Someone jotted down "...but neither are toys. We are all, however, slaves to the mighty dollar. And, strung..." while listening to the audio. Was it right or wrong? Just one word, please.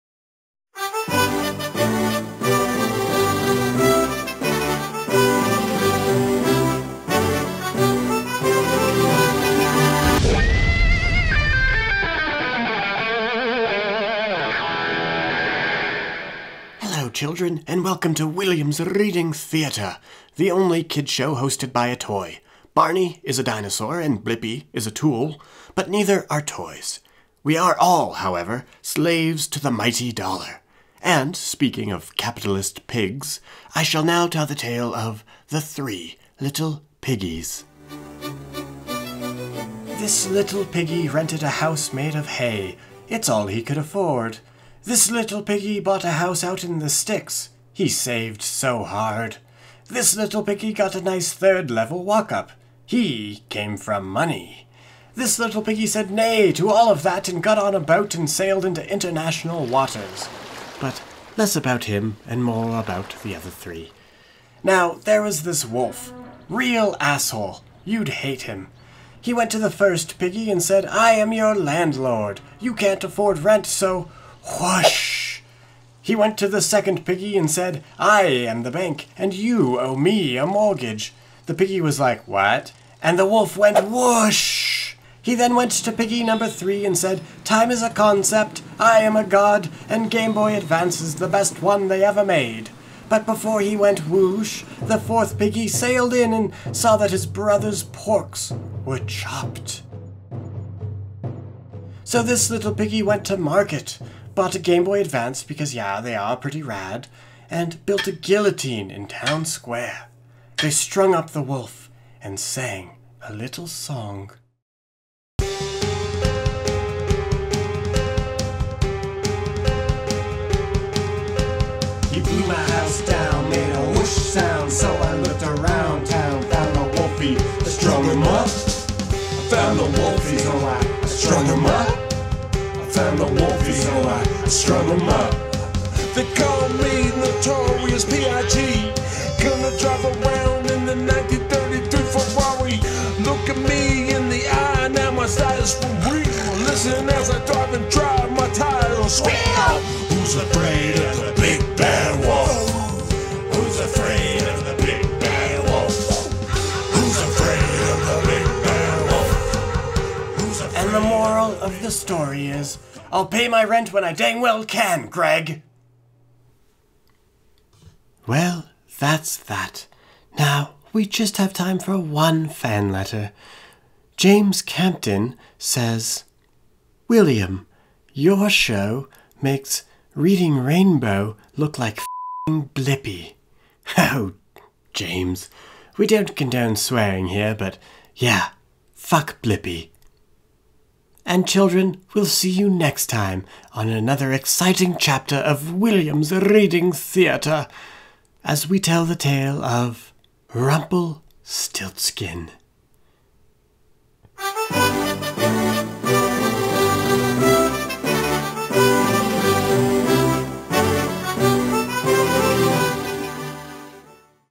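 wrong.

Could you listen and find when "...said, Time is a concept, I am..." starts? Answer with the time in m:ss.
1:26.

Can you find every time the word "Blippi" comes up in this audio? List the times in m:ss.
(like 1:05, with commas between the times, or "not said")
0:24, 3:02, 3:09.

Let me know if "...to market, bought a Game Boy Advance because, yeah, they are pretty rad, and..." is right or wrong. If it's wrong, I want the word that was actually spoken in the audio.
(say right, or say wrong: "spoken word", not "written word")
right.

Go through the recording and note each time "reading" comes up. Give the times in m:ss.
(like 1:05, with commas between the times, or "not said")
0:18, 3:00, 3:16.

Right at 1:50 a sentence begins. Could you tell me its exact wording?
They strung up the wolf and sang a little song.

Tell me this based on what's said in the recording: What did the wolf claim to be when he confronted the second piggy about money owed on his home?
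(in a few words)
The bank.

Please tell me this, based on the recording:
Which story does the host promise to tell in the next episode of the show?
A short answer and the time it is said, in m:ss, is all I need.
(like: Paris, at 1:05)
Rumpelstiltskin, at 3:20.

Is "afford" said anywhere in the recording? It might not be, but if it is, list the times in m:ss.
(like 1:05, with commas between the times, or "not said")
0:43, 1:13.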